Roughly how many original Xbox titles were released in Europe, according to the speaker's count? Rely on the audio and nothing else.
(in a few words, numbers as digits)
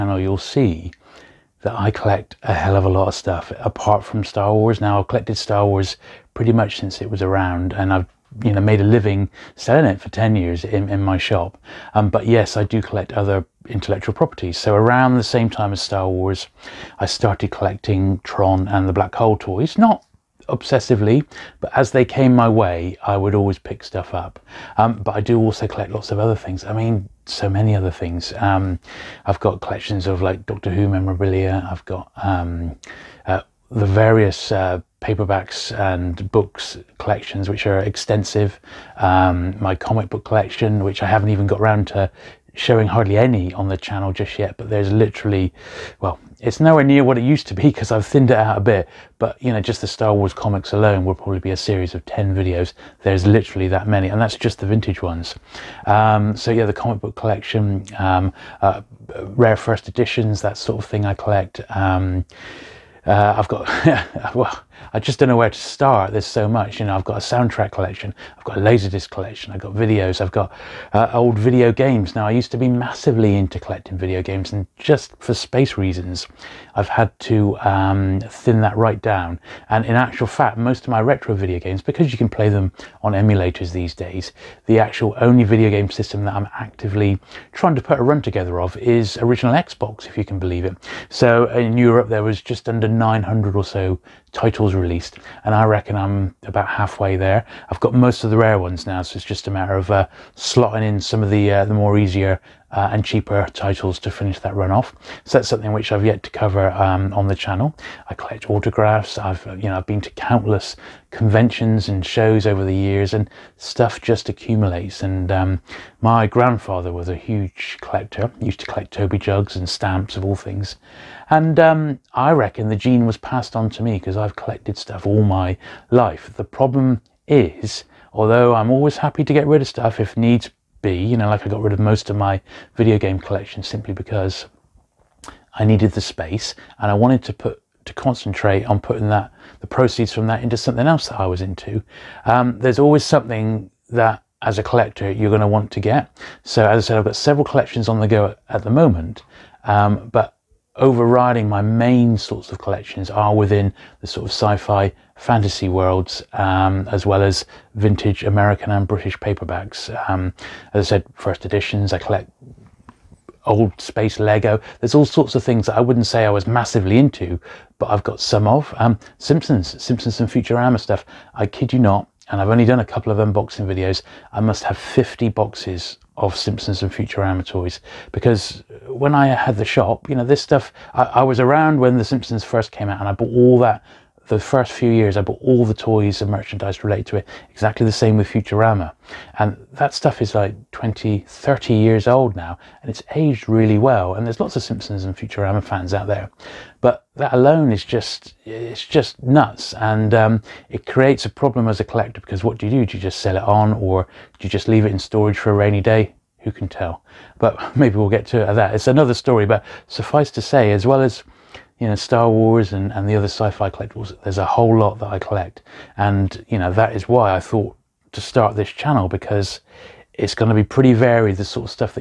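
900.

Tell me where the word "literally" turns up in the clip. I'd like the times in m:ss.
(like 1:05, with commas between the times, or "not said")
0:44, 0:53.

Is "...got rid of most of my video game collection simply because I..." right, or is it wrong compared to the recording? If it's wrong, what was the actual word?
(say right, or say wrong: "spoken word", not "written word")
right.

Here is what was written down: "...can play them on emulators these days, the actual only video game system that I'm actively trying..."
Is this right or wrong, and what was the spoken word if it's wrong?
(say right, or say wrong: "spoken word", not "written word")
right.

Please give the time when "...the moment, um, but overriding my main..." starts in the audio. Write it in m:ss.
2:28.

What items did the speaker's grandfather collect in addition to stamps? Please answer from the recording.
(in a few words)
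Toby jugs.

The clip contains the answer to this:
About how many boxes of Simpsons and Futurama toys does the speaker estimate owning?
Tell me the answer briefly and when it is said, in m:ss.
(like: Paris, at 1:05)
50, at 2:54.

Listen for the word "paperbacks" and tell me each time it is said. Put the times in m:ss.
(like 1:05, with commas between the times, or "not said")
0:35, 2:39.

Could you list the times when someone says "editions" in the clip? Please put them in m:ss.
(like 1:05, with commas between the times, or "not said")
0:59, 2:41.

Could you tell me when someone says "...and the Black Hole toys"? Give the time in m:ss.
0:18.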